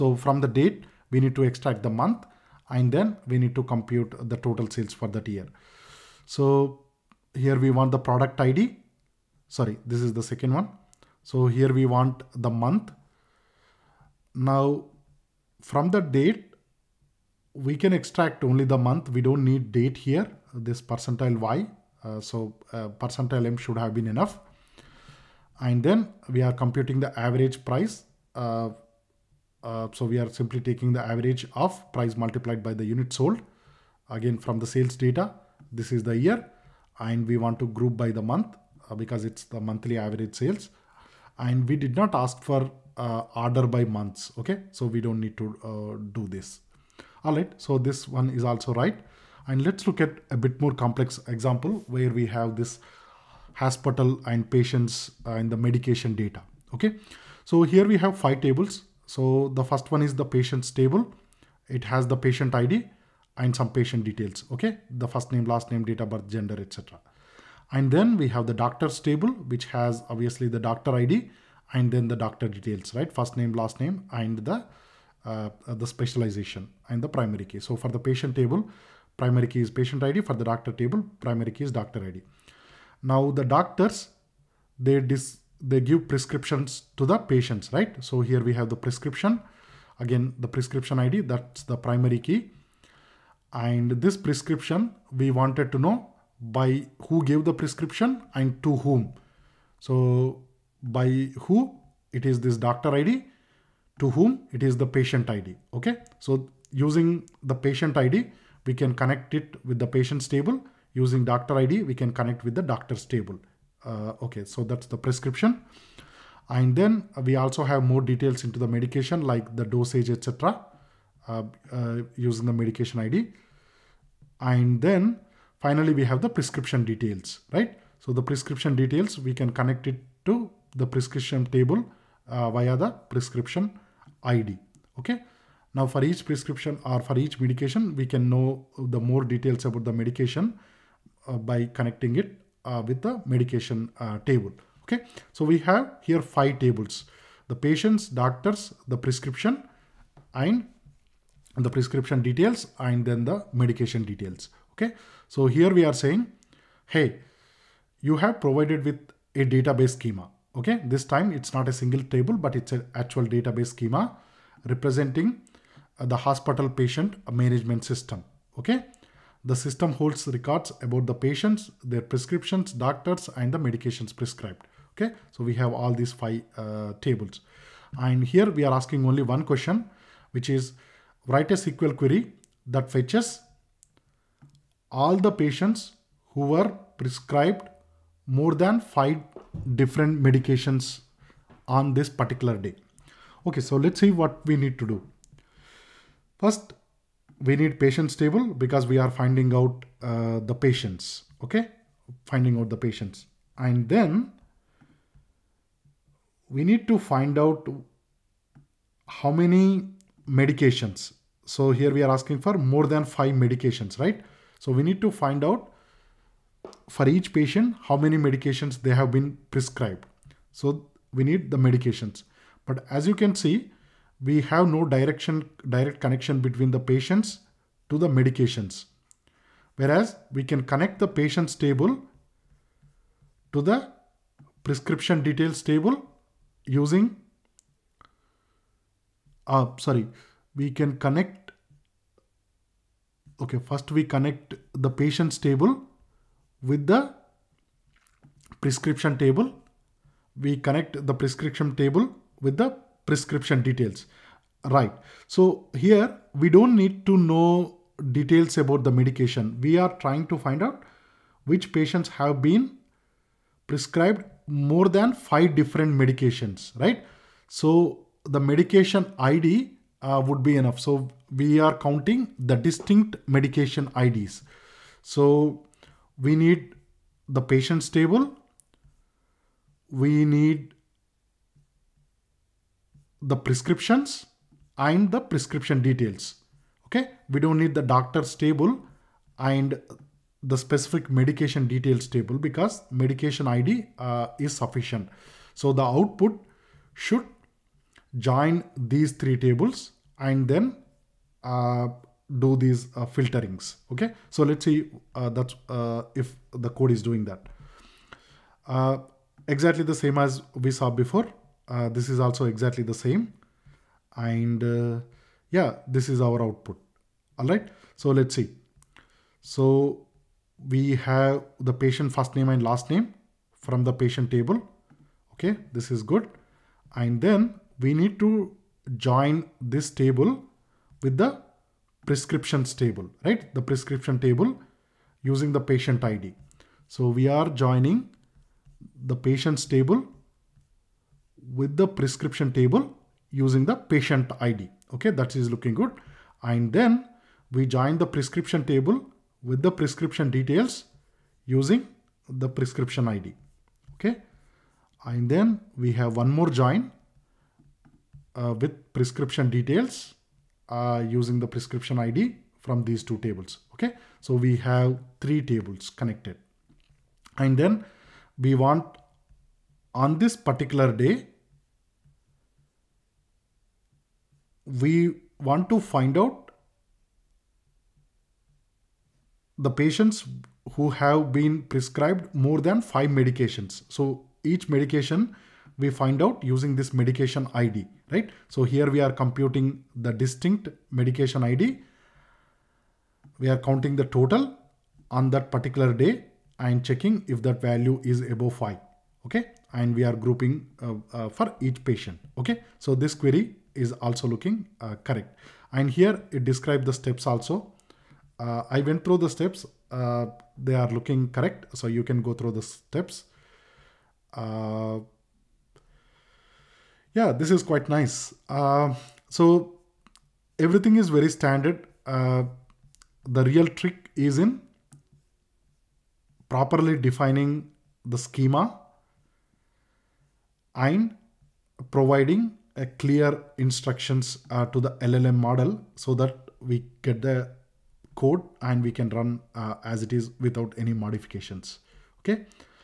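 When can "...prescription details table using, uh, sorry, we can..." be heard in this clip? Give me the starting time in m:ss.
3:54.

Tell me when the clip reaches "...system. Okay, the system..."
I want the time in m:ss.
2:47.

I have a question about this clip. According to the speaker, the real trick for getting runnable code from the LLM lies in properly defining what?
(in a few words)
The schema.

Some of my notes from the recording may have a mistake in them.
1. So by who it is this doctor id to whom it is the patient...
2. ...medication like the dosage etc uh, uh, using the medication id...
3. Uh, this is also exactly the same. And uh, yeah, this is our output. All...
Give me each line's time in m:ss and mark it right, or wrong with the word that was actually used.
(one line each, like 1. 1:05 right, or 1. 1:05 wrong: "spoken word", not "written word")
1. 1:39 right
2. 1:58 right
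3. 5:11 right.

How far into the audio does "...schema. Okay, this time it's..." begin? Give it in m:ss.
2:39.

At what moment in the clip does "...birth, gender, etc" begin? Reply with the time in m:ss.
1:06.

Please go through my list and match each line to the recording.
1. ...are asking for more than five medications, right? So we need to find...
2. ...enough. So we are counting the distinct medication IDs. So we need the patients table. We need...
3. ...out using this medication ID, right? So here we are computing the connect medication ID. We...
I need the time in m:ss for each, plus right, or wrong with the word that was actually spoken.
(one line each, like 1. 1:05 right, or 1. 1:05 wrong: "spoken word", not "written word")
1. 3:32 right
2. 4:30 right
3. 6:26 wrong: "distinct", not "connect".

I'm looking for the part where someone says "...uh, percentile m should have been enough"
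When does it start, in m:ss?
0:22.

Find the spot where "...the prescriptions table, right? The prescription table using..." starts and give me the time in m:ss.
5:31.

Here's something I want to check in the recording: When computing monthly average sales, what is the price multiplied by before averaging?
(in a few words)
Unit sold.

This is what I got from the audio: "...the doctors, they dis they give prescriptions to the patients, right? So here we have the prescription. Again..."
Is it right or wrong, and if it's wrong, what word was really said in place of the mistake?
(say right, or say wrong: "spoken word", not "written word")
right.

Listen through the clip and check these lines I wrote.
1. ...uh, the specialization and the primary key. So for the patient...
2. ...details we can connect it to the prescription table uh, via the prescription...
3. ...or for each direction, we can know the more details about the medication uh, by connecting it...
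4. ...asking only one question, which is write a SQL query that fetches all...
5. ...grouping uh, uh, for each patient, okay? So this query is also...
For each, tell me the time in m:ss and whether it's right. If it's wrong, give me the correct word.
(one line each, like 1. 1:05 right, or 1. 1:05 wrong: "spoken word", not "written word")
1. 1:15 right
2. 2:08 right
3. 2:16 wrong: "medication", not "direction"
4. 2:58 right
5. 6:40 right.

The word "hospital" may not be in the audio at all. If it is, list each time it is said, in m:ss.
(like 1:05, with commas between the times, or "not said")
0:53, 2:46.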